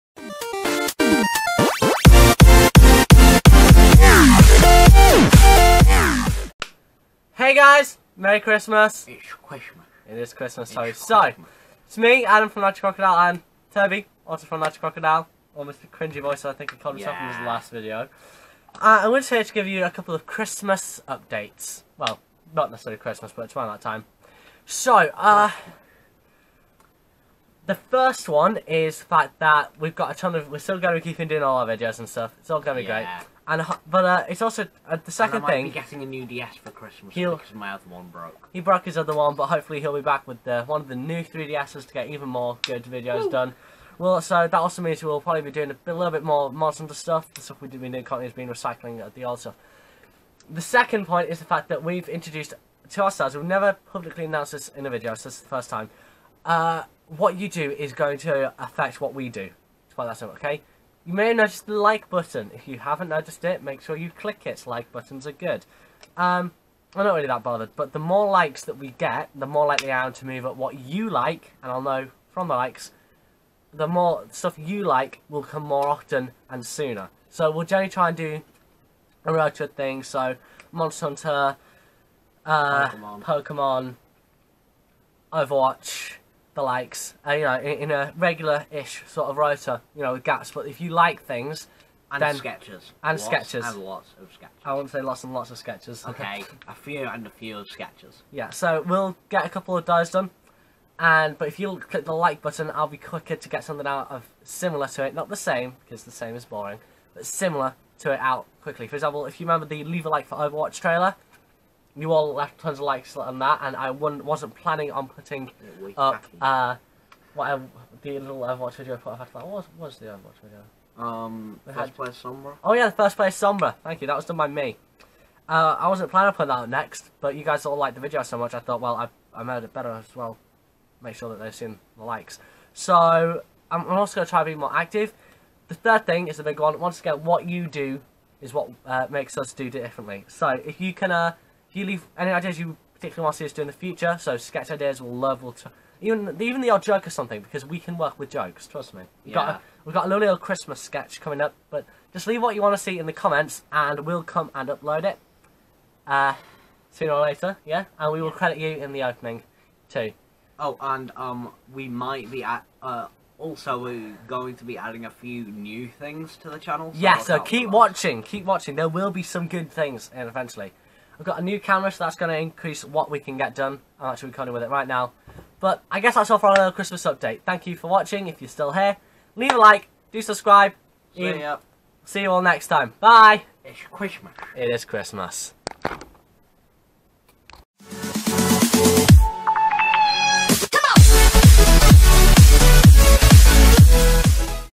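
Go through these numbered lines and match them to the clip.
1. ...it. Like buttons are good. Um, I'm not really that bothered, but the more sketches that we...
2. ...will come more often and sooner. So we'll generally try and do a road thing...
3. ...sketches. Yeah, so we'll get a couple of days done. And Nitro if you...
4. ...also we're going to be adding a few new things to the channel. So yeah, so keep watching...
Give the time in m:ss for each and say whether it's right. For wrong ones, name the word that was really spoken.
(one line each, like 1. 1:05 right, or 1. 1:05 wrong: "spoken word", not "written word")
1. 1:04 wrong: "likes", not "sketches"
2. 1:15 right
3. 1:37 wrong: "But", not "Nitro"
4. 2:43 right.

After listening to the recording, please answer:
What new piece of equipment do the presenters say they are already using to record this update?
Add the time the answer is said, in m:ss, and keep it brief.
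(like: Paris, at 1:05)
camera, at 2:51.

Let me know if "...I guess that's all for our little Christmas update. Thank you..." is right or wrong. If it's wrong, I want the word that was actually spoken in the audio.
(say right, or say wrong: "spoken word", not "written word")
right.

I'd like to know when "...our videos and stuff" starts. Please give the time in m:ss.
0:31.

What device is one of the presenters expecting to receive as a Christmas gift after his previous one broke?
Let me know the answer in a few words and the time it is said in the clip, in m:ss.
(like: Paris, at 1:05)
DS, at 0:36.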